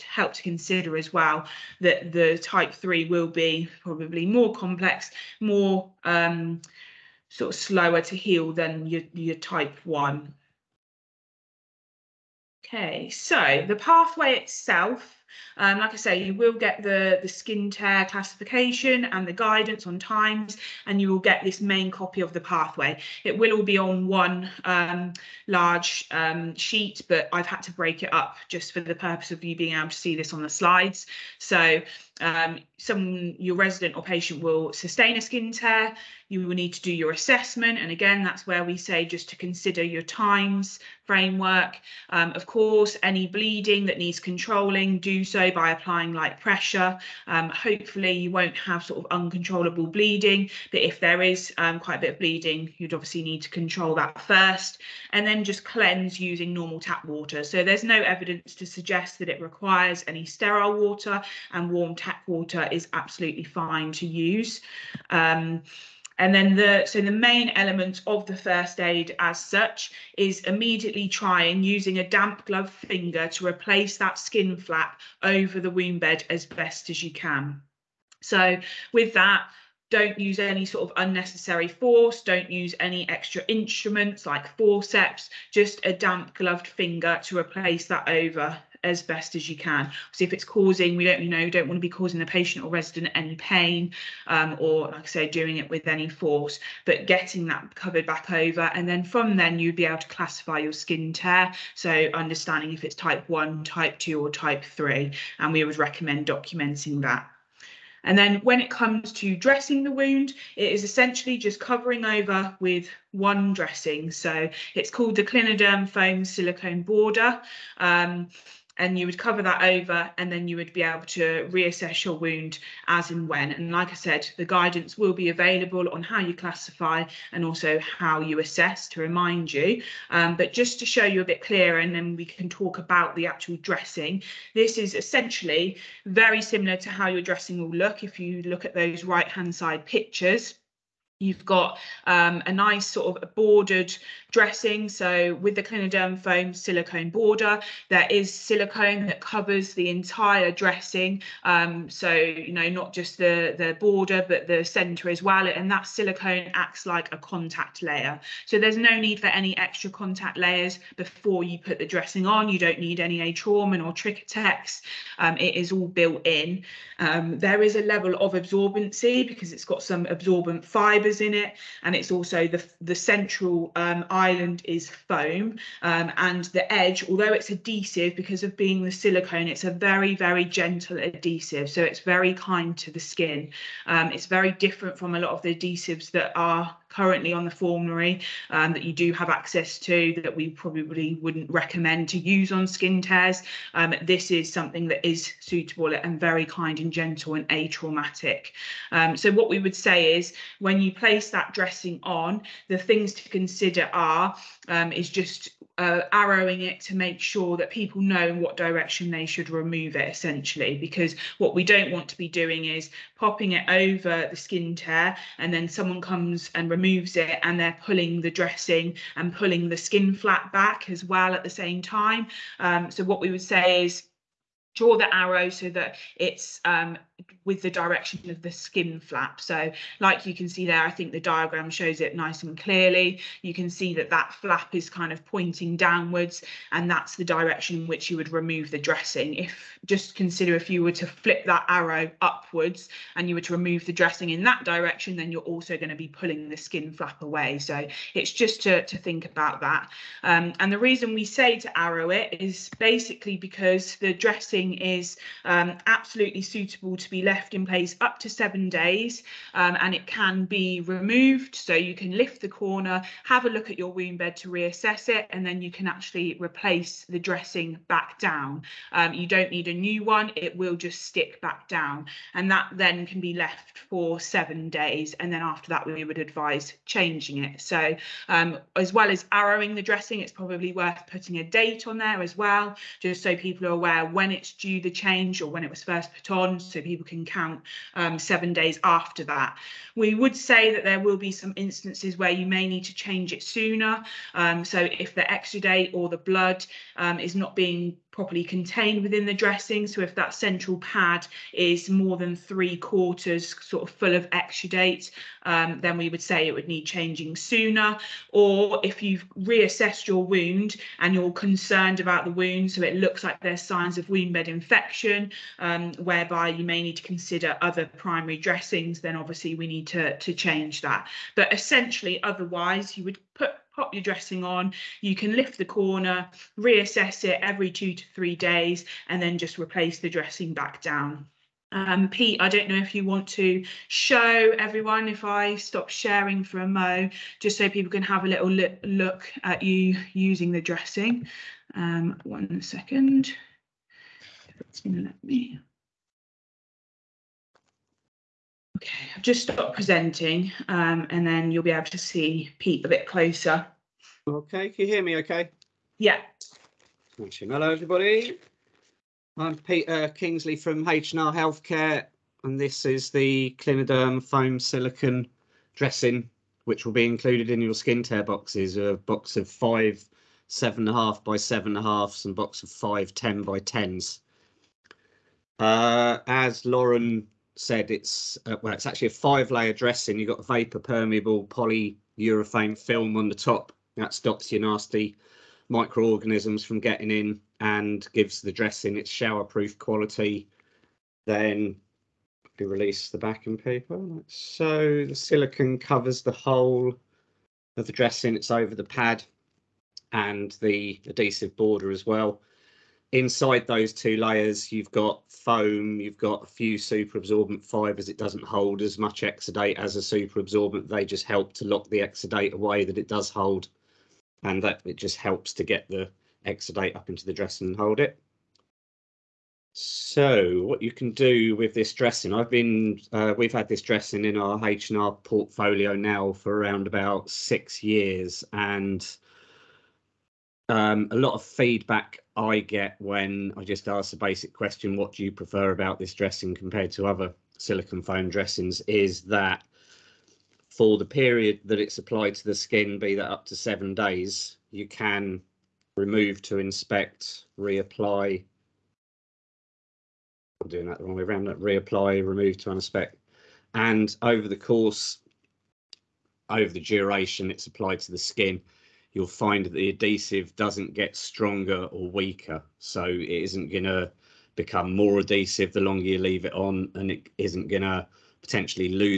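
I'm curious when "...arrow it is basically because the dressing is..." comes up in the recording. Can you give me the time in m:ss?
4:11.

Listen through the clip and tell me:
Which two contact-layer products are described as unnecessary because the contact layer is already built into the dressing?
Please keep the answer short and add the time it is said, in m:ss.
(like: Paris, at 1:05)
Atrauman or Tricotex, at 2:43.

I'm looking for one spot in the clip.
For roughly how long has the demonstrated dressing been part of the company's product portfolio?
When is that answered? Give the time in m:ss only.
7:06.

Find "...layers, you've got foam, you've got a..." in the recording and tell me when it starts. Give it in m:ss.
6:44.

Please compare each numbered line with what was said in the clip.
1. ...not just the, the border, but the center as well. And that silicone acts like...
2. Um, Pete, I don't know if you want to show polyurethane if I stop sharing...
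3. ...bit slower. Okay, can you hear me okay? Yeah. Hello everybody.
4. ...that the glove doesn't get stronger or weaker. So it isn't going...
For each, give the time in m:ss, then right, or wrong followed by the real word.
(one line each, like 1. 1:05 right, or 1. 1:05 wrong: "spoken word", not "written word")
1. 2:32 right
2. 5:31 wrong: "everyone", not "polyurethane"
3. 5:52 wrong: "closer", not "slower"
4. 7:39 wrong: "adhesive", not "glove".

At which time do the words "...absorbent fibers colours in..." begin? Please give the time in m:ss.
2:50.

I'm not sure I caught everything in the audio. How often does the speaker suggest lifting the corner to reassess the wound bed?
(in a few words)
Every 2 to 3 days.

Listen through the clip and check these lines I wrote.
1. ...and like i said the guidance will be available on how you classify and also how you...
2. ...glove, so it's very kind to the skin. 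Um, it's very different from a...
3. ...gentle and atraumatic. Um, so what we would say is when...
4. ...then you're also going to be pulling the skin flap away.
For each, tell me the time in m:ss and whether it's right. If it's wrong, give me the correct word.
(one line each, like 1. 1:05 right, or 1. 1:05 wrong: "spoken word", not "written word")
1. 2:03 right
2. 3:00 wrong: "adhesive", not "glove"
3. 3:16 right
4. 4:05 right.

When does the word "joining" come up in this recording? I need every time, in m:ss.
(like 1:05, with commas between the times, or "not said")
not said.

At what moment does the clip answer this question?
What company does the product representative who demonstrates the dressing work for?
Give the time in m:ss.
6:00.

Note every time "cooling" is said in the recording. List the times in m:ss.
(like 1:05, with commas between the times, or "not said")
not said.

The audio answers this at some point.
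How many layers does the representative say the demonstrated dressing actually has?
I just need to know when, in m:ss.
6:19.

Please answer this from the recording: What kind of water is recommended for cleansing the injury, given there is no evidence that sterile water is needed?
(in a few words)
Warm tap water.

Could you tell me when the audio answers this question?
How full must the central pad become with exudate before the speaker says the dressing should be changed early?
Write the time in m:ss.
5:02.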